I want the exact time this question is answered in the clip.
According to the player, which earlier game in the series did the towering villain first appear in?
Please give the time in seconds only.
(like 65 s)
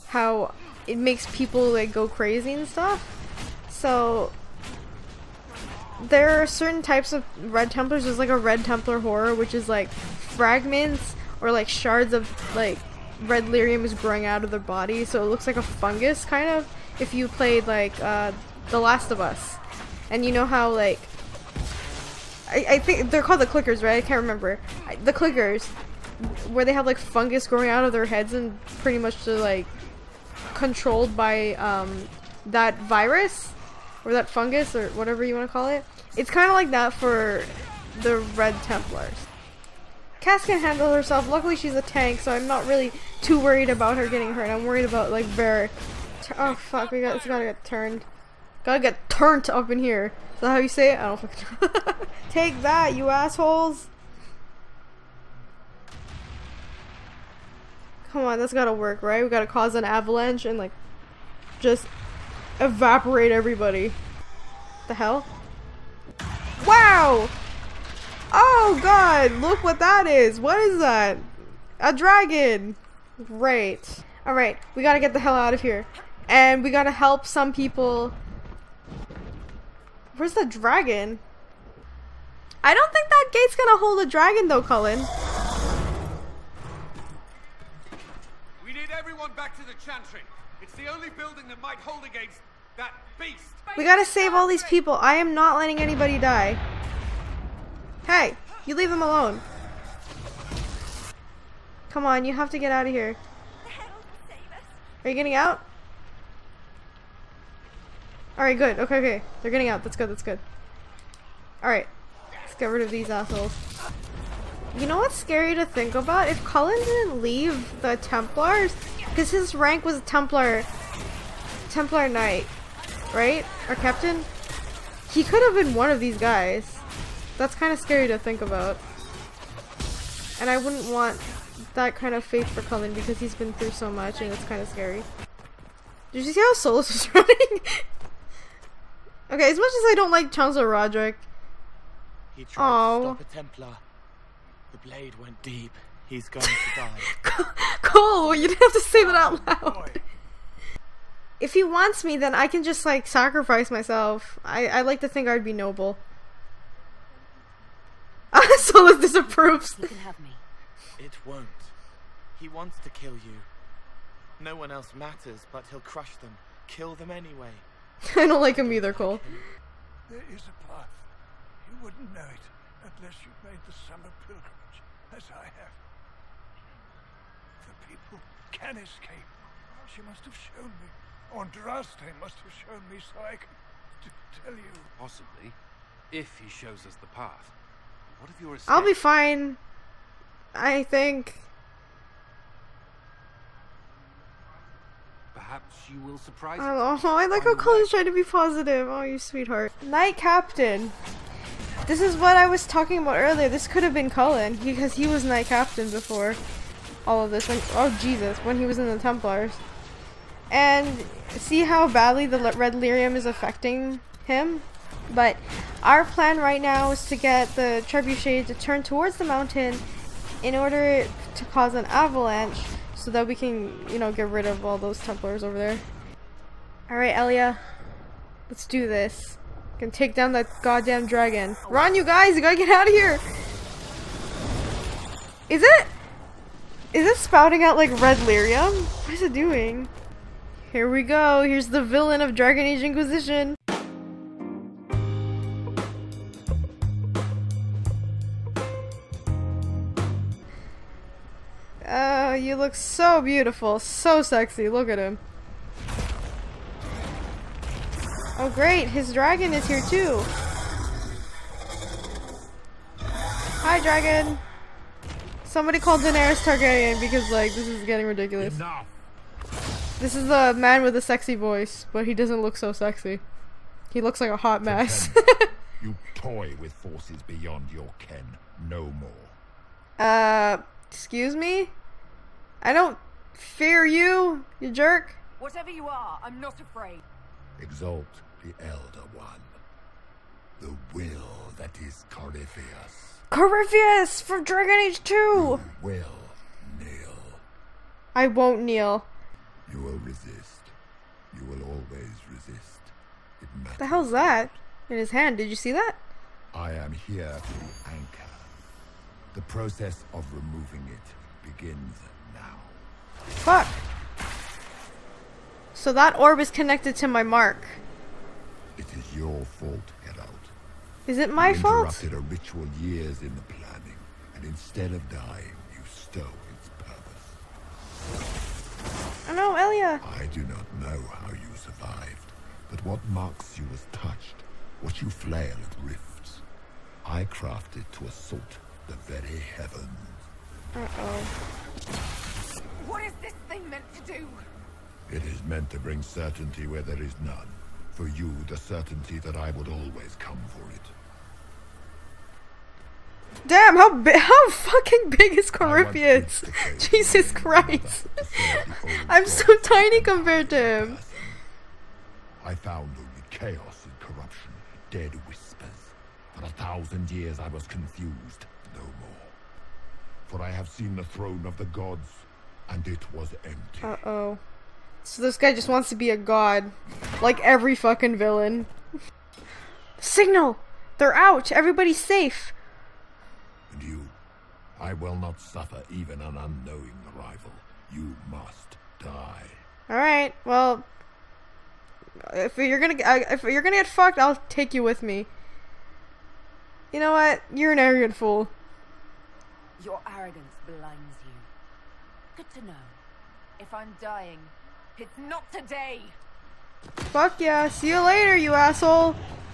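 294 s.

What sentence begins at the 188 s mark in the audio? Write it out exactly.
What if you're I'll be fine.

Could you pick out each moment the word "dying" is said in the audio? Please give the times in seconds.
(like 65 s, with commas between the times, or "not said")
325 s, 403 s.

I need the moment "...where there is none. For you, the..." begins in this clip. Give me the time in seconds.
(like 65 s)
346 s.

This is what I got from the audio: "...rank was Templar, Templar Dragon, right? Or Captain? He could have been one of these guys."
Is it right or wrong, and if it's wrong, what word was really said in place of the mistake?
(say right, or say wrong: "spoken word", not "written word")
wrong: "Knight", not "Dragon".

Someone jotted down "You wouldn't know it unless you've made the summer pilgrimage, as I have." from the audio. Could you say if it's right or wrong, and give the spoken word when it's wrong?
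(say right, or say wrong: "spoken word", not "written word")
right.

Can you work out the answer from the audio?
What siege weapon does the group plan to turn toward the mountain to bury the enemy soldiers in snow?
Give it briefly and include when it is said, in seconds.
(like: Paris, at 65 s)
trebuchet, at 217 s.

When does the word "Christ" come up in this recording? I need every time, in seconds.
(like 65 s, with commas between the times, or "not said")
357 s.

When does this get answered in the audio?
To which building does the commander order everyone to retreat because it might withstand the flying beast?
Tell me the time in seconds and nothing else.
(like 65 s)
89 s.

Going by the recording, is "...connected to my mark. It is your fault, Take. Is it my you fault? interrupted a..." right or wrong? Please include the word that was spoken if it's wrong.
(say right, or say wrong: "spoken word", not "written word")
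wrong: "Herald", not "Take".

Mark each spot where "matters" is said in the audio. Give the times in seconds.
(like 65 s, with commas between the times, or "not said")
164 s, 303 s.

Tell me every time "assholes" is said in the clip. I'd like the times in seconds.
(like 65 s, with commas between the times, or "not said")
53 s, 113 s, 408 s.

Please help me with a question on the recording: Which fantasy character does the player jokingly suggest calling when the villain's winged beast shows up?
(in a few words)
Daenerys Targaryen.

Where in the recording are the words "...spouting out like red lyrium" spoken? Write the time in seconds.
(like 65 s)
237 s.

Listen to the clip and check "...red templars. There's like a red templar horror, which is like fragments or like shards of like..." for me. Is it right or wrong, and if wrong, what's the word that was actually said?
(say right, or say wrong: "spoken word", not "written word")
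right.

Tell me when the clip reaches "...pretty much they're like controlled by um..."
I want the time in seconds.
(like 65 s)
28 s.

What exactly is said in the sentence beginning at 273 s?
He looks like a hot mess.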